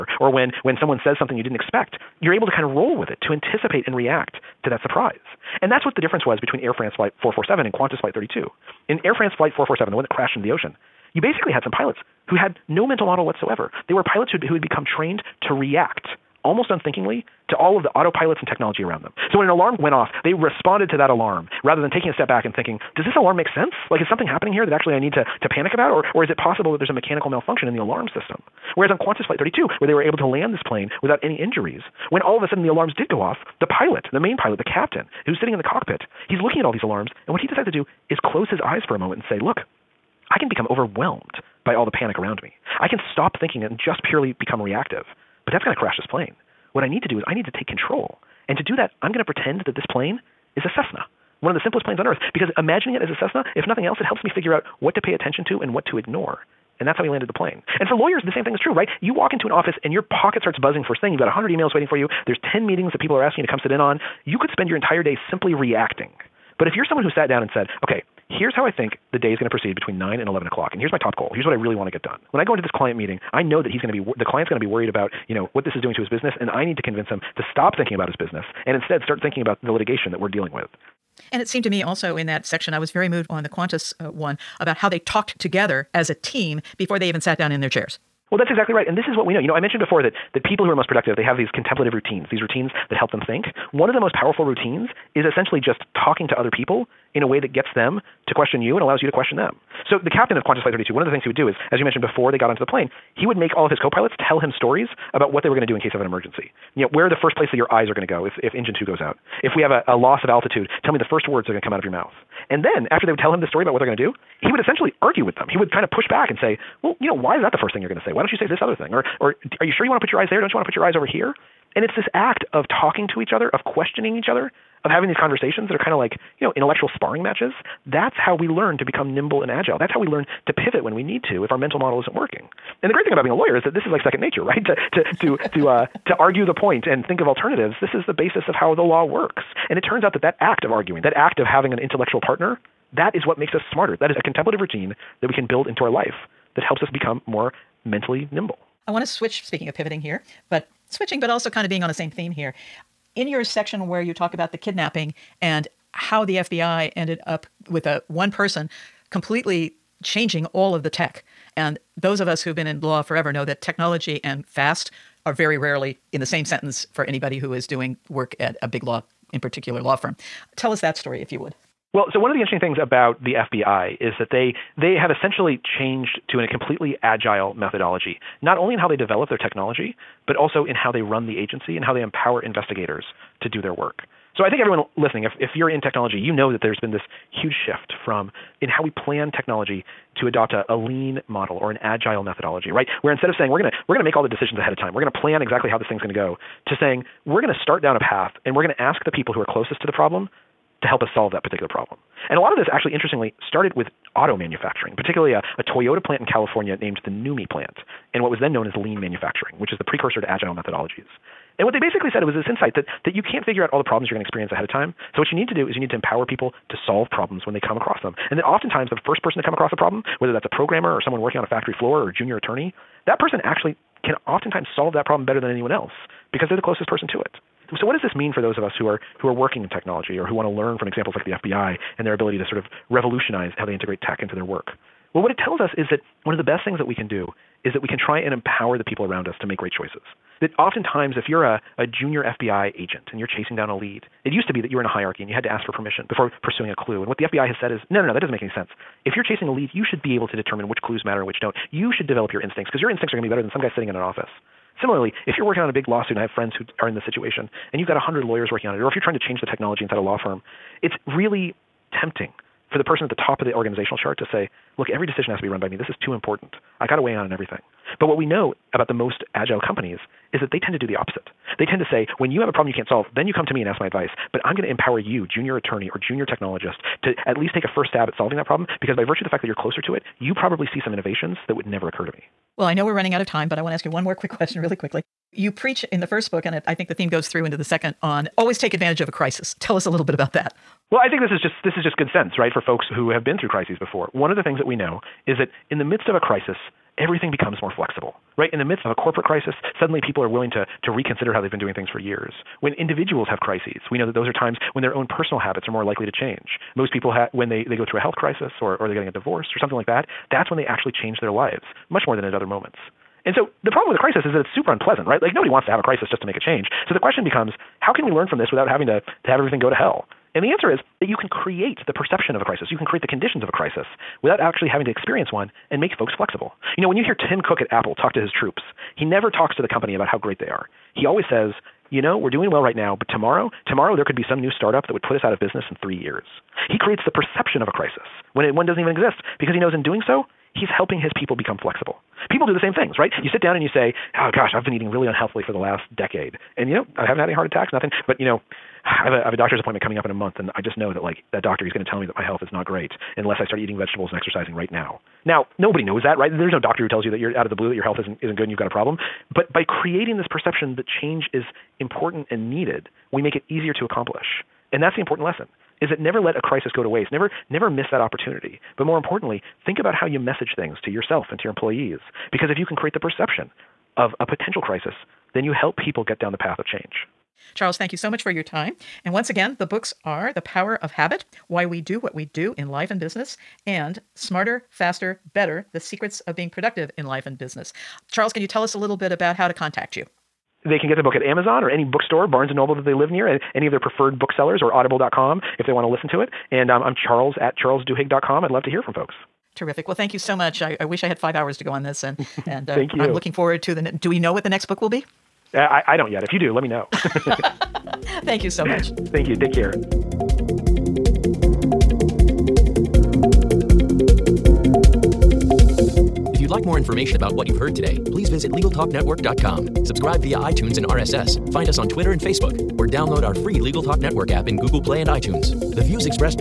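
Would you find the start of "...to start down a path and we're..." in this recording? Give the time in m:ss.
3:17.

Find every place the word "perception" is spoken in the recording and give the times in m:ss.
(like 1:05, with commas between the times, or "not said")
5:21, 5:37, 6:00, 6:12.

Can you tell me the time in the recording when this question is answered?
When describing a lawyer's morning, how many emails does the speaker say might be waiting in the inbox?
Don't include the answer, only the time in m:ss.
1:01.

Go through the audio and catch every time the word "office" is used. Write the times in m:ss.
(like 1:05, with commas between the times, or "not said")
0:59, 4:14.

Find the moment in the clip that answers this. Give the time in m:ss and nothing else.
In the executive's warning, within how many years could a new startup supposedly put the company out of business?
5:35.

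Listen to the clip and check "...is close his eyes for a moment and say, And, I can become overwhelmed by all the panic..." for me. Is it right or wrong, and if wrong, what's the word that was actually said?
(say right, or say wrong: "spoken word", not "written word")
wrong: "Look", not "And".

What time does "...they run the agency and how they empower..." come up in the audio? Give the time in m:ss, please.
3:00.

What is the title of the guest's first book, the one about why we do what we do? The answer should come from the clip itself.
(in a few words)
The Power of Habit.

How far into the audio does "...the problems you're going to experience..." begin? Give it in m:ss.
3:33.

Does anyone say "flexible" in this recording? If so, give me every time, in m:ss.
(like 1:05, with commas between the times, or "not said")
4:57, 5:26, 5:41.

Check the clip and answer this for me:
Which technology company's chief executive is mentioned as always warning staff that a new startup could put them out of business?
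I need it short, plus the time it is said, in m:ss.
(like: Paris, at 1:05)
Apple, at 5:27.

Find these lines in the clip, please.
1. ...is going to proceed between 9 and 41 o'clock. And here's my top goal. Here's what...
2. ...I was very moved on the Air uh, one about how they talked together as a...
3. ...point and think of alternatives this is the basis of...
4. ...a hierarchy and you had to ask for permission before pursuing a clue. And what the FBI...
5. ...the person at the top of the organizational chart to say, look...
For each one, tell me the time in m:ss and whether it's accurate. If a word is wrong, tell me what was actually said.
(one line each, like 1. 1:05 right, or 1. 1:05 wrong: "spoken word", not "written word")
1. 1:09 wrong: "11", not "41"
2. 1:22 wrong: "Qantas", not "Air"
3. 2:16 right
4. 4:04 right
5. 4:22 right.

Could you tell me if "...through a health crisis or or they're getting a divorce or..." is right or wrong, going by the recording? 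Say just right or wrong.
right.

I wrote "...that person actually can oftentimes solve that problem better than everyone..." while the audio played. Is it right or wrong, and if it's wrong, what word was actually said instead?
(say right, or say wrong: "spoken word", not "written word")
wrong: "anyone", not "everyone".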